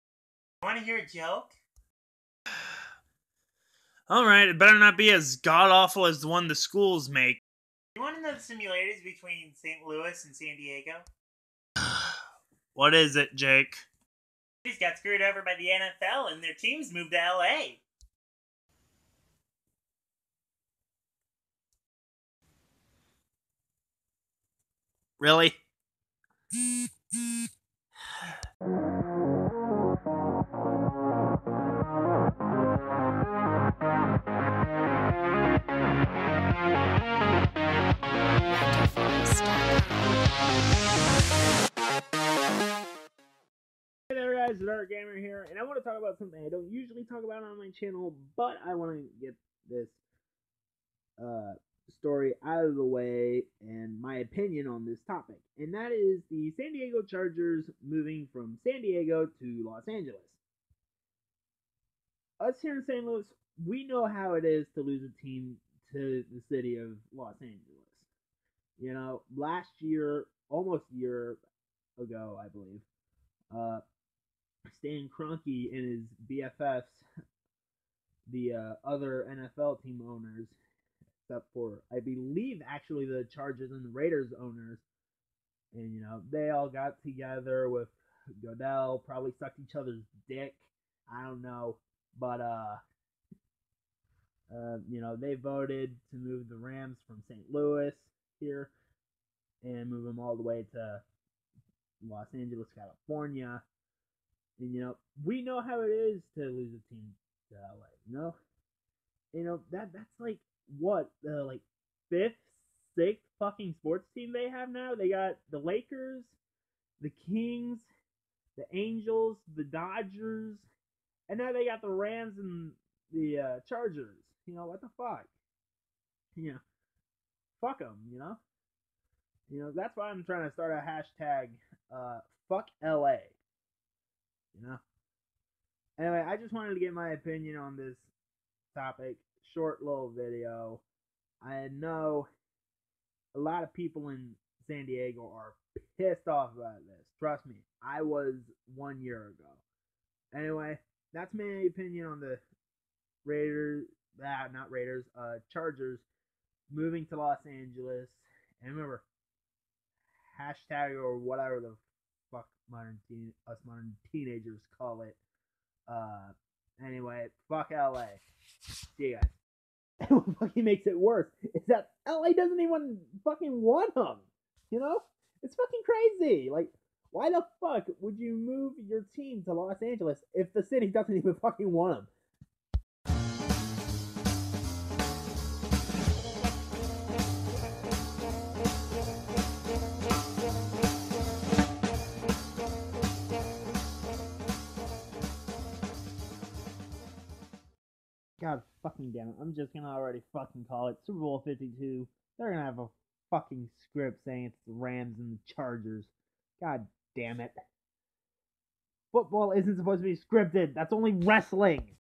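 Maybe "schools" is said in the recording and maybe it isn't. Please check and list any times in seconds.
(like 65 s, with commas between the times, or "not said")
6 s.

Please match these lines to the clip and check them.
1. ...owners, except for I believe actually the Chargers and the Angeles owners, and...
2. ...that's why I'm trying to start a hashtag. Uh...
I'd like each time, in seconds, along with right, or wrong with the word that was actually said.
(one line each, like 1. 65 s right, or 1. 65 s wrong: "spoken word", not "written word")
1. 80 s wrong: "Raiders", not "Angeles"
2. 129 s right.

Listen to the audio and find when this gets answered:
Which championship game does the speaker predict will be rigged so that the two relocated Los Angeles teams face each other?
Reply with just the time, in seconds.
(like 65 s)
201 s.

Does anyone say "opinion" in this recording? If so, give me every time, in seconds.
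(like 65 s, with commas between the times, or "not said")
54 s, 137 s, 151 s.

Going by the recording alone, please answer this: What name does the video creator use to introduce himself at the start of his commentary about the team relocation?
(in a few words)
Art Gamer.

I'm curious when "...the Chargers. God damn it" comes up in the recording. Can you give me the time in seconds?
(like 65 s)
205 s.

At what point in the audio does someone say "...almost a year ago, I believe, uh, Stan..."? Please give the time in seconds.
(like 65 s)
70 s.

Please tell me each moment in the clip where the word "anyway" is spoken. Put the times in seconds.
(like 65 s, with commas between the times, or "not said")
135 s, 150 s, 166 s.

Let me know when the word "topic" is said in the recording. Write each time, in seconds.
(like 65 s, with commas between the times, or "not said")
55 s, 138 s.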